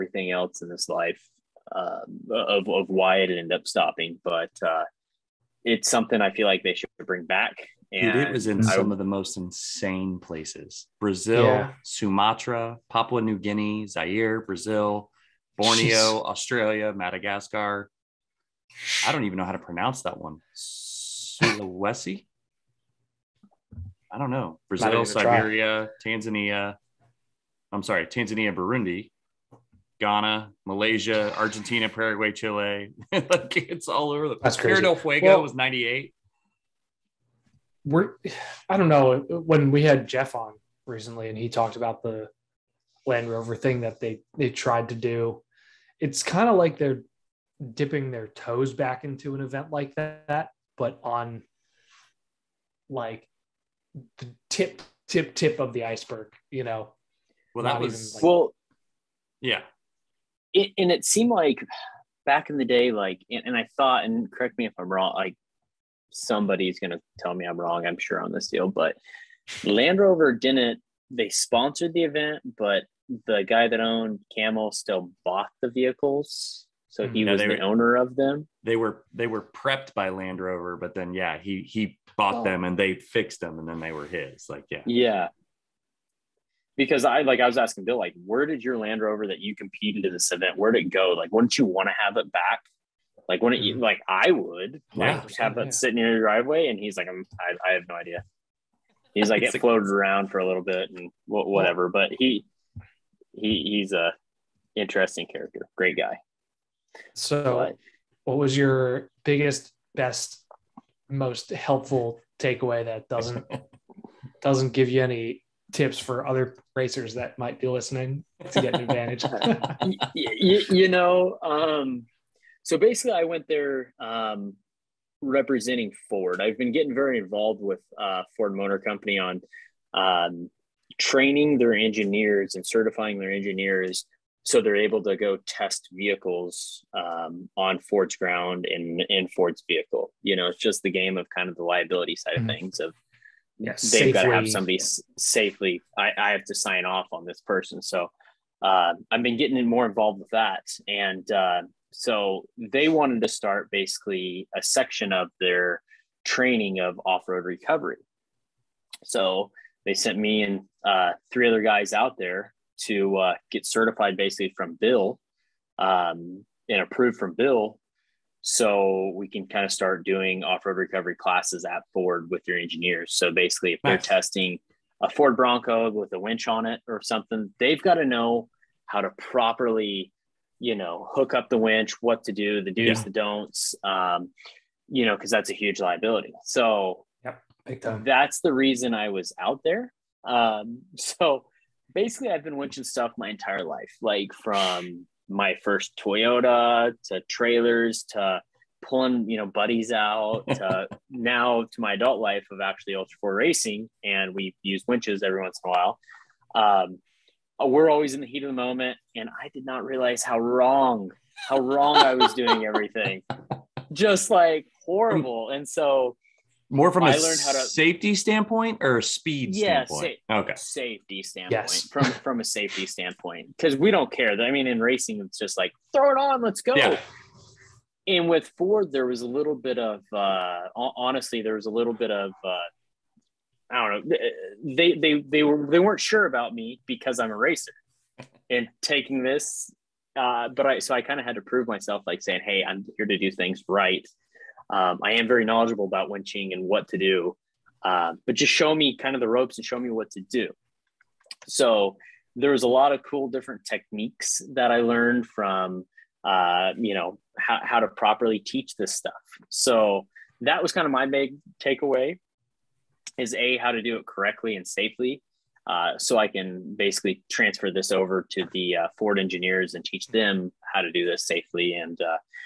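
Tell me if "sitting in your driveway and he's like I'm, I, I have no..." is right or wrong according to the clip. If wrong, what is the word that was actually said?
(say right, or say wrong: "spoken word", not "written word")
right.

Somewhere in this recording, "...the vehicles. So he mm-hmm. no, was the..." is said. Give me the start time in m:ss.
1:15.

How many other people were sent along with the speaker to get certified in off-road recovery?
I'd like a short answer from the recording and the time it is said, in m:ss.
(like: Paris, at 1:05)
3, at 2:41.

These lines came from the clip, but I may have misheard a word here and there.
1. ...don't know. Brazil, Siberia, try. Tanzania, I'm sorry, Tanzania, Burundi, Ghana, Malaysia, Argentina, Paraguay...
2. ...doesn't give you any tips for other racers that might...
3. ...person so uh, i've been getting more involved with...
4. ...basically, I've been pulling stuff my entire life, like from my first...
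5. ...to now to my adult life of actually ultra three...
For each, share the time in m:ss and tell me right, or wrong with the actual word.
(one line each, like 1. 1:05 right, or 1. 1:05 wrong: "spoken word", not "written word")
1. 0:24 right
2. 1:54 right
3. 2:27 right
4. 3:11 wrong: "winching", not "pulling"
5. 3:20 wrong: "four", not "three".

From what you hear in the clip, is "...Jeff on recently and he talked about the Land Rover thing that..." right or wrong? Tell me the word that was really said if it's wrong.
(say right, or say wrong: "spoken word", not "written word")
right.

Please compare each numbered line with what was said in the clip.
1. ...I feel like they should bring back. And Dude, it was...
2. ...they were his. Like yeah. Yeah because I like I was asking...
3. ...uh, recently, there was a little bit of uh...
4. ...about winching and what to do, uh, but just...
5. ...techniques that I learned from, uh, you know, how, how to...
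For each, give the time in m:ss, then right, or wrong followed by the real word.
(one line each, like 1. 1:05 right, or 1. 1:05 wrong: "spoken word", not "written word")
1. 0:06 right
2. 1:23 right
3. 3:50 wrong: "honestly", not "recently"
4. 4:05 right
5. 4:13 right.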